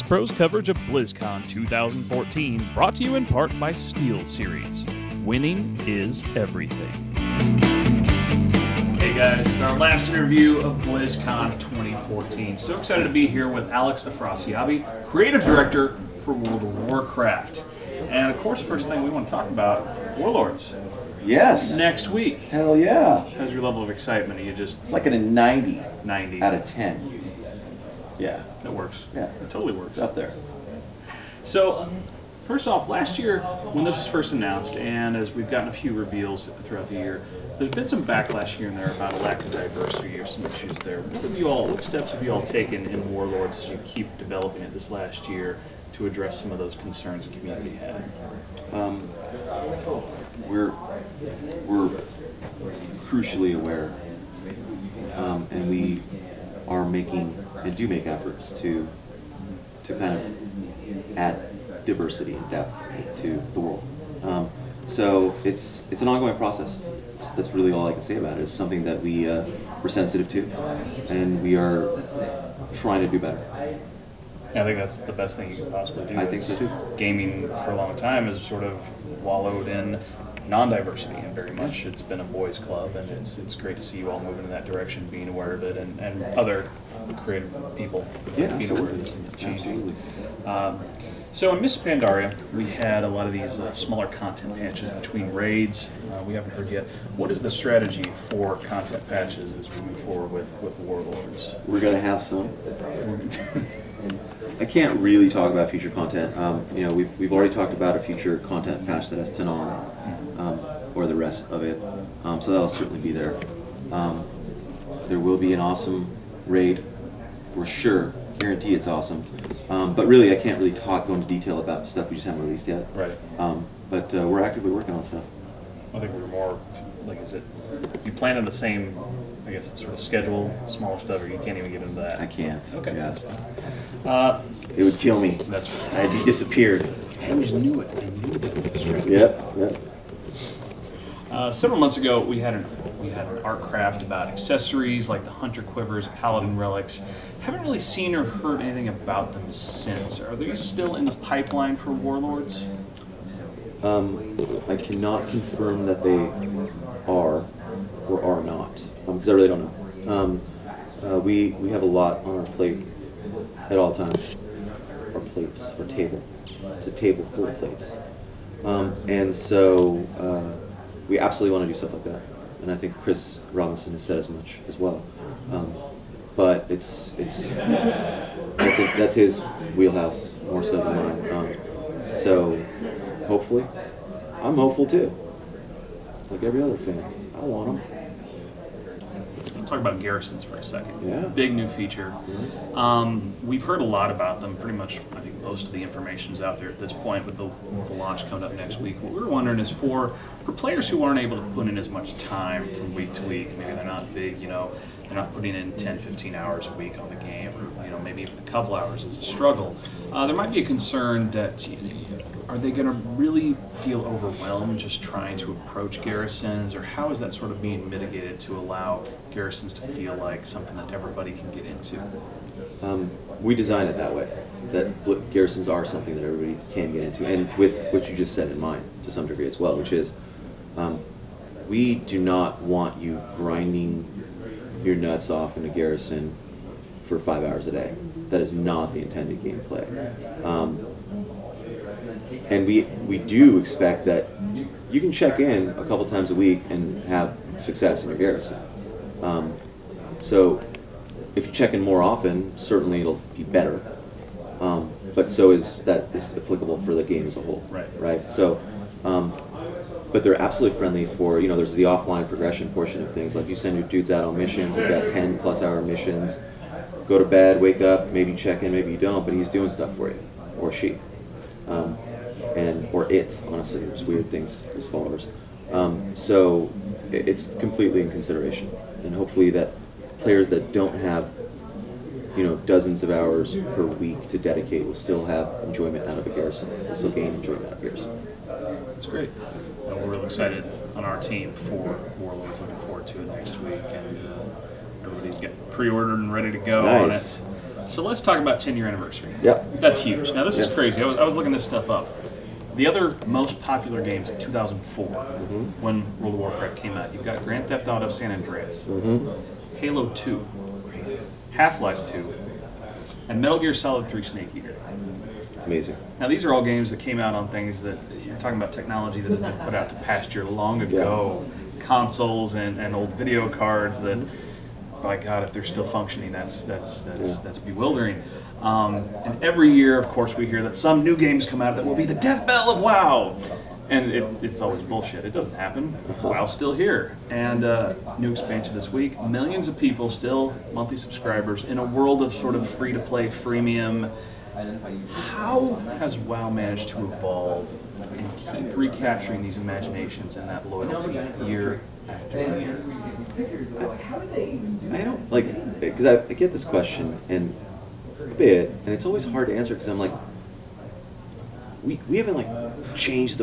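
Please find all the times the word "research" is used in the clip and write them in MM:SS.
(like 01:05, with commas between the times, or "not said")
not said.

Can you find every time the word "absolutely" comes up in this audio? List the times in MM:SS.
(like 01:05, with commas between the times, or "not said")
01:28, 02:51, 04:20.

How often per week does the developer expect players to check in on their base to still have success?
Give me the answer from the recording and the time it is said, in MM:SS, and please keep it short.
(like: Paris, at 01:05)
a couple times, at 04:05.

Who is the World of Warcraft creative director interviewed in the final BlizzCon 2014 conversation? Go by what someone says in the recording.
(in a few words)
Alex Afrasiabi.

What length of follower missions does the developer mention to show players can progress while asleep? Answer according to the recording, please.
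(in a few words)
ten plus hour.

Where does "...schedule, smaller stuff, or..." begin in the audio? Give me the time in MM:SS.
02:09.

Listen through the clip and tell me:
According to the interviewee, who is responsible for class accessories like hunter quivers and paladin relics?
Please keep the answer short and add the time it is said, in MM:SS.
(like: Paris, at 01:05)
Chris Robinson, at 02:53.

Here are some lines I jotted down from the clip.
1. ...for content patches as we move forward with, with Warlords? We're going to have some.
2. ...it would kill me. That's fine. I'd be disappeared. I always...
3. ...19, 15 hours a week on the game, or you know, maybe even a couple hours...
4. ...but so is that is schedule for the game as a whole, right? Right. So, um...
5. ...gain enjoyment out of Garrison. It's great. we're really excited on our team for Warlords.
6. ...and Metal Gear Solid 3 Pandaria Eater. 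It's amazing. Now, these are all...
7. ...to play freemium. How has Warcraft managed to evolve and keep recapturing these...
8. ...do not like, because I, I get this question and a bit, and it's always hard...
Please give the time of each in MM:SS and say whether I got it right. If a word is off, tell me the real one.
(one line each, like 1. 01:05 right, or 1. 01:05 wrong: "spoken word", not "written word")
1. 01:38 right
2. 02:14 right
3. 03:25 wrong: "10", not "19"
4. 04:15 wrong: "applicable", not "schedule"
5. 04:47 right
6. 05:13 wrong: "Snake", not "Pandaria"
7. 05:42 wrong: "WoW", not "Warcraft"
8. 05:53 right.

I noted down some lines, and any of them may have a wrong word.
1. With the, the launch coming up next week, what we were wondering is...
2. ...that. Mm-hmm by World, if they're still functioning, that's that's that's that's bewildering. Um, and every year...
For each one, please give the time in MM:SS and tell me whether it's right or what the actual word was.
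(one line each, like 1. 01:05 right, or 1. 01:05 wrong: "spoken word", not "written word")
1. 03:17 right
2. 05:23 wrong: "God", not "World".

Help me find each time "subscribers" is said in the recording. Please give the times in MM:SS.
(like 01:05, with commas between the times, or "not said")
05:40.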